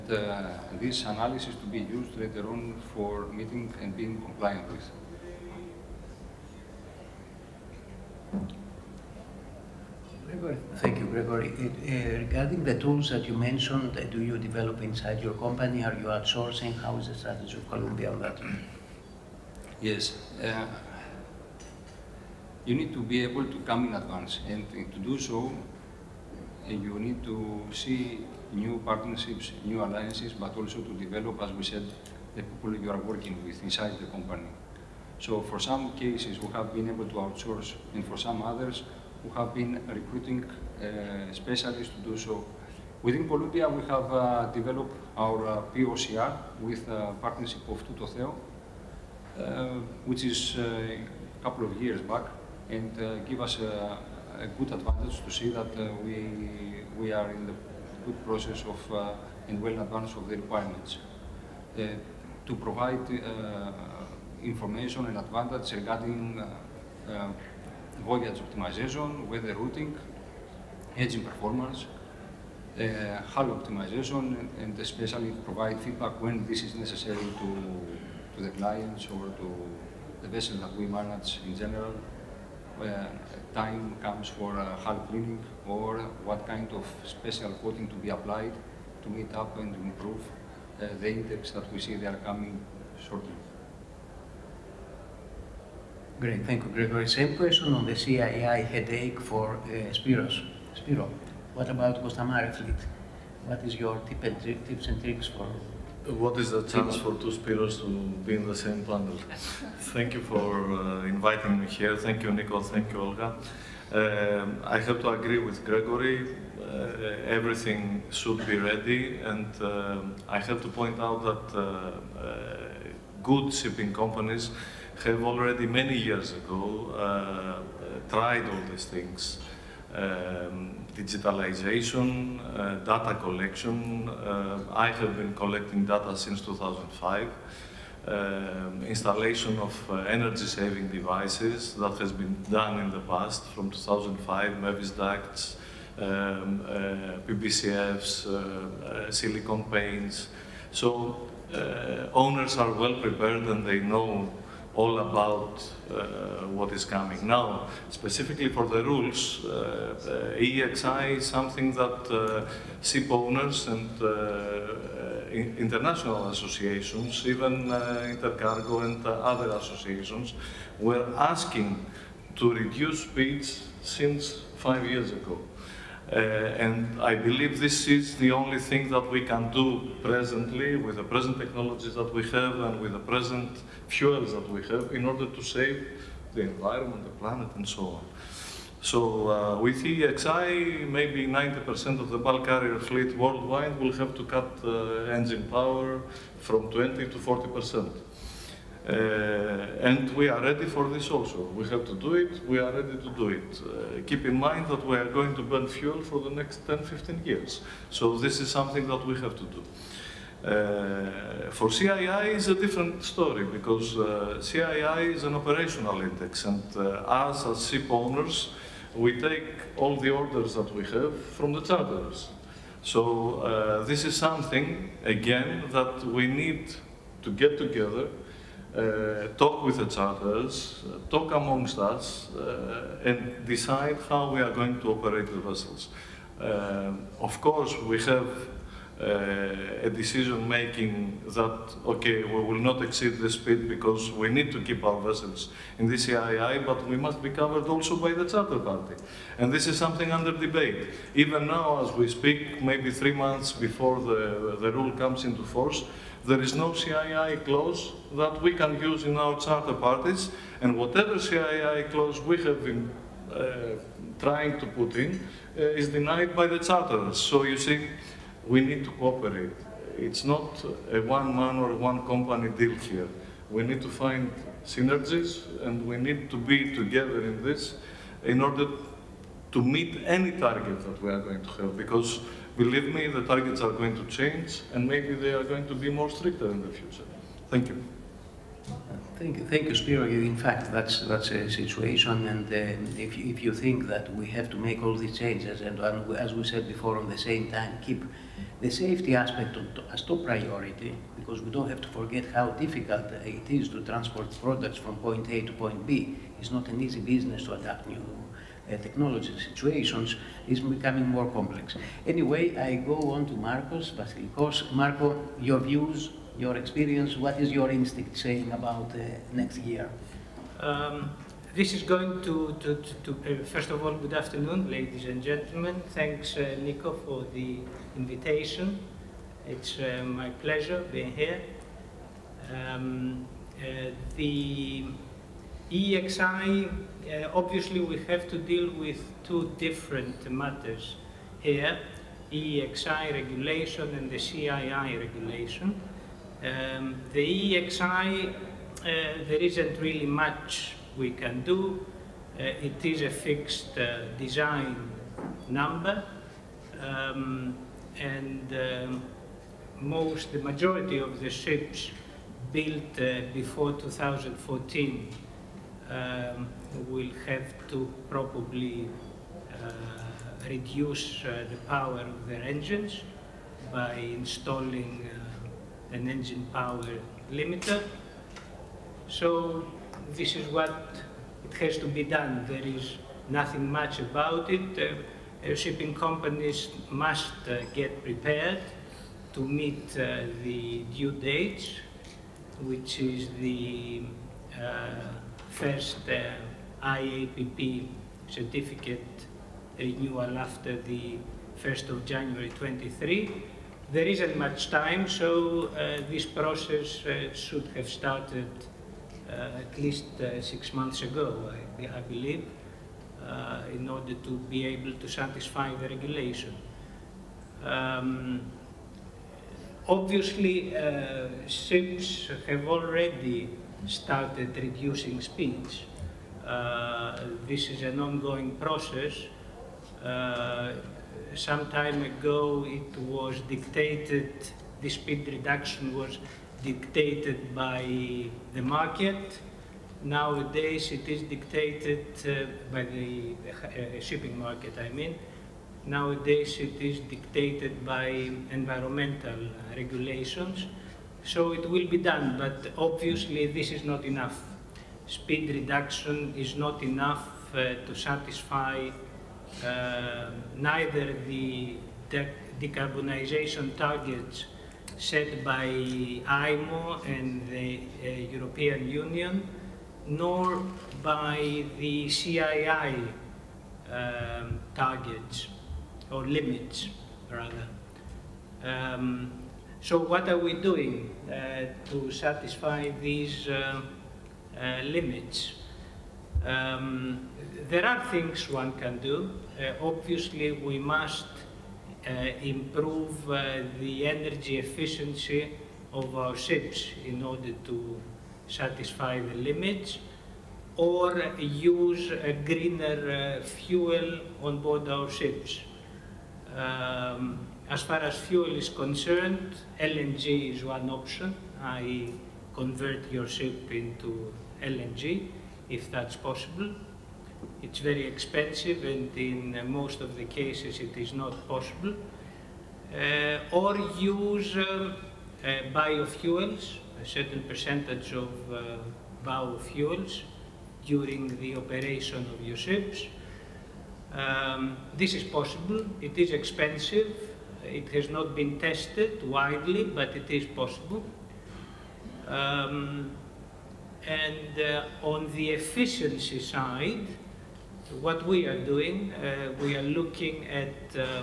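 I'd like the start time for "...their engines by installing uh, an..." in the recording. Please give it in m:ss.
6:12.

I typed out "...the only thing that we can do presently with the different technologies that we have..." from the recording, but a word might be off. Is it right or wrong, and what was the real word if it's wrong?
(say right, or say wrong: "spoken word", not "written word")
wrong: "present", not "different".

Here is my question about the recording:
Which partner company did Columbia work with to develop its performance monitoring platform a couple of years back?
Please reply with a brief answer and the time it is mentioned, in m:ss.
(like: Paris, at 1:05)
Tototheo, at 0:47.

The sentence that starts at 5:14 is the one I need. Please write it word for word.
Marco, your views, your experience, what is your instinct saying about uh, next year?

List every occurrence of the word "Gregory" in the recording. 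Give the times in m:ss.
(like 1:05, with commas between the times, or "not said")
0:11, 1:36, 1:55.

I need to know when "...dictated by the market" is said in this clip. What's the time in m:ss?
7:16.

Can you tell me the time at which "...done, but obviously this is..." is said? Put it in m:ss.
7:31.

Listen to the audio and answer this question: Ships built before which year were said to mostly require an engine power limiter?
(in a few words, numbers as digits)
2014.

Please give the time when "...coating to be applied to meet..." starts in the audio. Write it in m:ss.
1:27.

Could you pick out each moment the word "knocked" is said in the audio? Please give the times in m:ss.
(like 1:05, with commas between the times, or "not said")
not said.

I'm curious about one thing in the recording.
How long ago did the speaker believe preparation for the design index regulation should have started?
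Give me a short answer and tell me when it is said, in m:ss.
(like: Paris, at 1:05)
6 months, at 6:50.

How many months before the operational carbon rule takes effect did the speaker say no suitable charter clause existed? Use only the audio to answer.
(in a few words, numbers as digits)
3 months.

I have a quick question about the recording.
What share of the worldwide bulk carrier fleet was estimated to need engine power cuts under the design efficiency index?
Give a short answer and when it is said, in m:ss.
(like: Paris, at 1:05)
90%, at 3:11.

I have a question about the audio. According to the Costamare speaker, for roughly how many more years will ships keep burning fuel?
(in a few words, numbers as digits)
10 to 15 years.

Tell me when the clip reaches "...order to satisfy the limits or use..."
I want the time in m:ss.
8:17.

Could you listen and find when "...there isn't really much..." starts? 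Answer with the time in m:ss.
5:48.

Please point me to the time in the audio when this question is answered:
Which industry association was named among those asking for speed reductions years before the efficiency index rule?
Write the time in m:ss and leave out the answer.
2:48.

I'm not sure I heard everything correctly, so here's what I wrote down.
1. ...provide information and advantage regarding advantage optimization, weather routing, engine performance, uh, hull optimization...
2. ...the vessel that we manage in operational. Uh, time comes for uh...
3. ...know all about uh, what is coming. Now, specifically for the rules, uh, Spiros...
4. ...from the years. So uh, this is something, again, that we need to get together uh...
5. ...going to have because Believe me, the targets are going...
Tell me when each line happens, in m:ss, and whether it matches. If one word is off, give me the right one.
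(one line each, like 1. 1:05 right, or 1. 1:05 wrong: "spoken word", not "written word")
1. 1:02 wrong: "voyage", not "advantage"
2. 1:20 wrong: "general", not "operational"
3. 2:33 wrong: "EEXI", not "Spiros"
4. 3:41 wrong: "charters", not "years"
5. 4:41 right.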